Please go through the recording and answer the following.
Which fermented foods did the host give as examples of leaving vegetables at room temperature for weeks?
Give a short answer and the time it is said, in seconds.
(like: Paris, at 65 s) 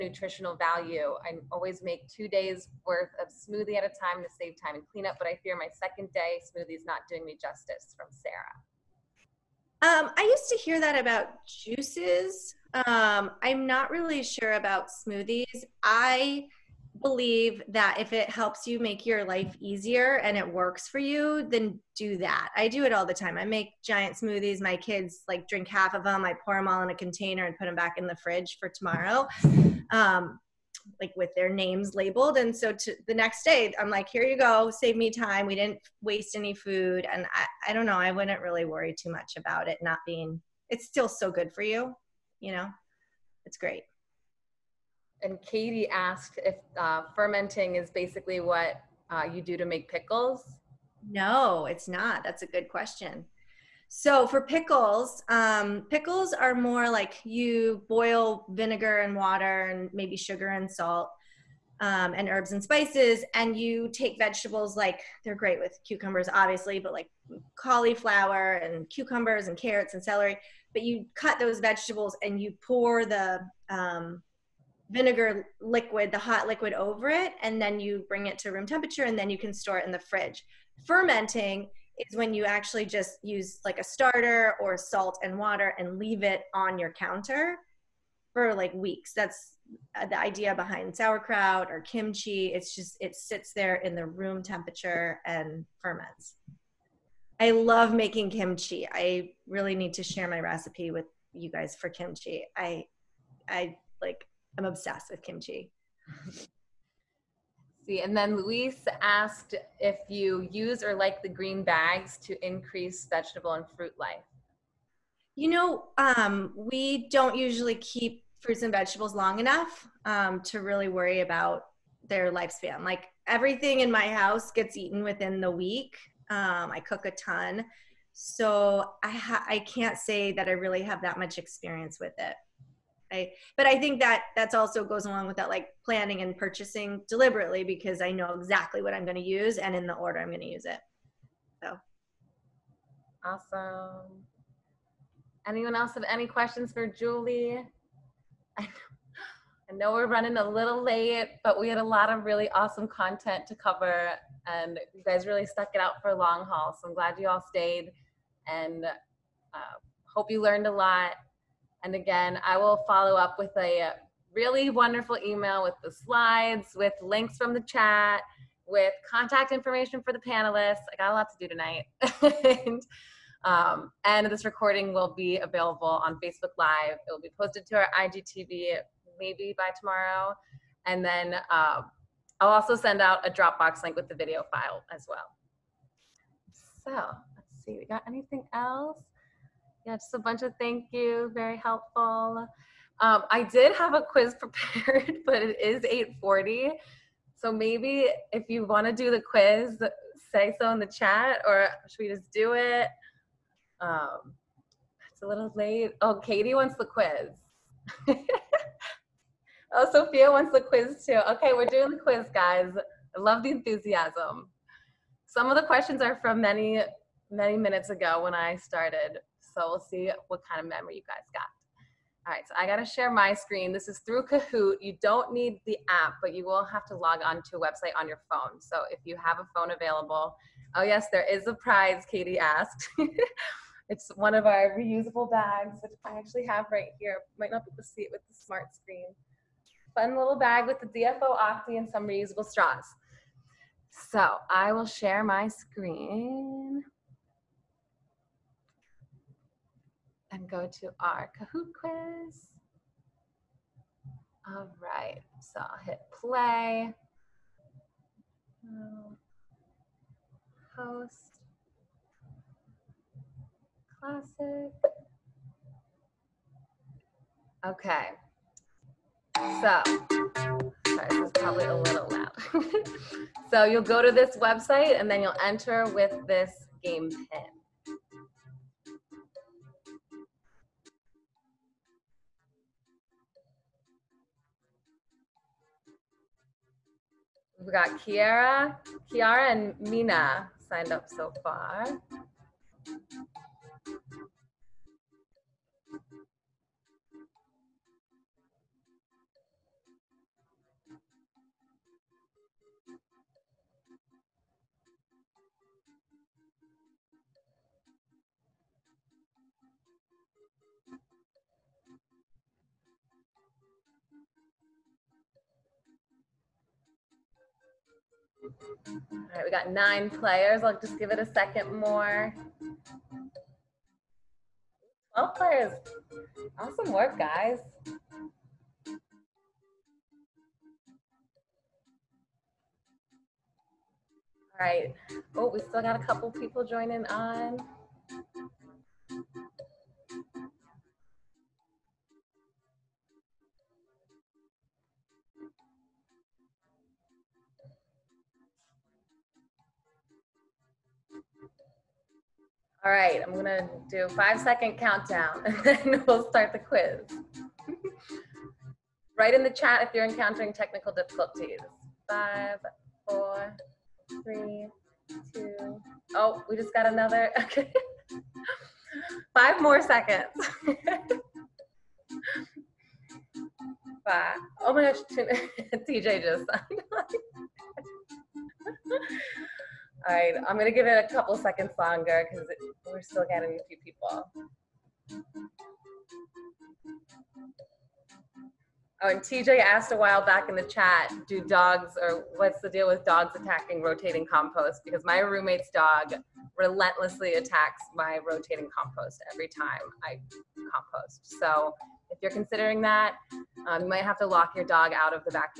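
sauerkraut or kimchi, at 90 s.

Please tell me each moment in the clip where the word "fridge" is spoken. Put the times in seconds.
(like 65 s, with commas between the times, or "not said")
28 s, 79 s.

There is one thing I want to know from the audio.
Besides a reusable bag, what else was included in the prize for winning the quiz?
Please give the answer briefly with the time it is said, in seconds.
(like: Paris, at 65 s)
reusable straws, at 242 s.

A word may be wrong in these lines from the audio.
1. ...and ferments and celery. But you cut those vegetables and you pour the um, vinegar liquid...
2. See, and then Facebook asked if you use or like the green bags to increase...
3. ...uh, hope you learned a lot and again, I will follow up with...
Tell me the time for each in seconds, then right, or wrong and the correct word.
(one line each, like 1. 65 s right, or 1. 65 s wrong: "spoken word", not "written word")
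1. 69 s wrong: "carrots", not "ferments"
2. 107 s wrong: "Luis", not "Facebook"
3. 158 s right.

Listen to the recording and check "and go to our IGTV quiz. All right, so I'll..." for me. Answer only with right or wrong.
wrong.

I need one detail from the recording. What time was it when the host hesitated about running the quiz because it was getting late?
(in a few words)
8:40.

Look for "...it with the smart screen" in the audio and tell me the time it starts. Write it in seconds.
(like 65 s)
238 s.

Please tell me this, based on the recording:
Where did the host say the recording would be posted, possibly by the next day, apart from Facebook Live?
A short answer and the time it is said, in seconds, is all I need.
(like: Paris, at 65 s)
IGTV, at 177 s.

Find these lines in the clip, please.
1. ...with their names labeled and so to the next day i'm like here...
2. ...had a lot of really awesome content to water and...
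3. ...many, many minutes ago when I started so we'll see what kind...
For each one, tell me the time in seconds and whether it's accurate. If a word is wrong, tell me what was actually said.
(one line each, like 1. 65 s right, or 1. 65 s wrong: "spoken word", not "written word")
1. 31 s right
2. 151 s wrong: "cover", not "water"
3. 216 s right.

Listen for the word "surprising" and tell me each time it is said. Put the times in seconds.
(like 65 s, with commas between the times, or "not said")
not said.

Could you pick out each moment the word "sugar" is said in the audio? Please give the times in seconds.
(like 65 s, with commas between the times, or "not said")
60 s.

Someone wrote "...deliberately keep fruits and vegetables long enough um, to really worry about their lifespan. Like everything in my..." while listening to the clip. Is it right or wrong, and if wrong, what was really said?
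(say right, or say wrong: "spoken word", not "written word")
wrong: "usually", not "deliberately".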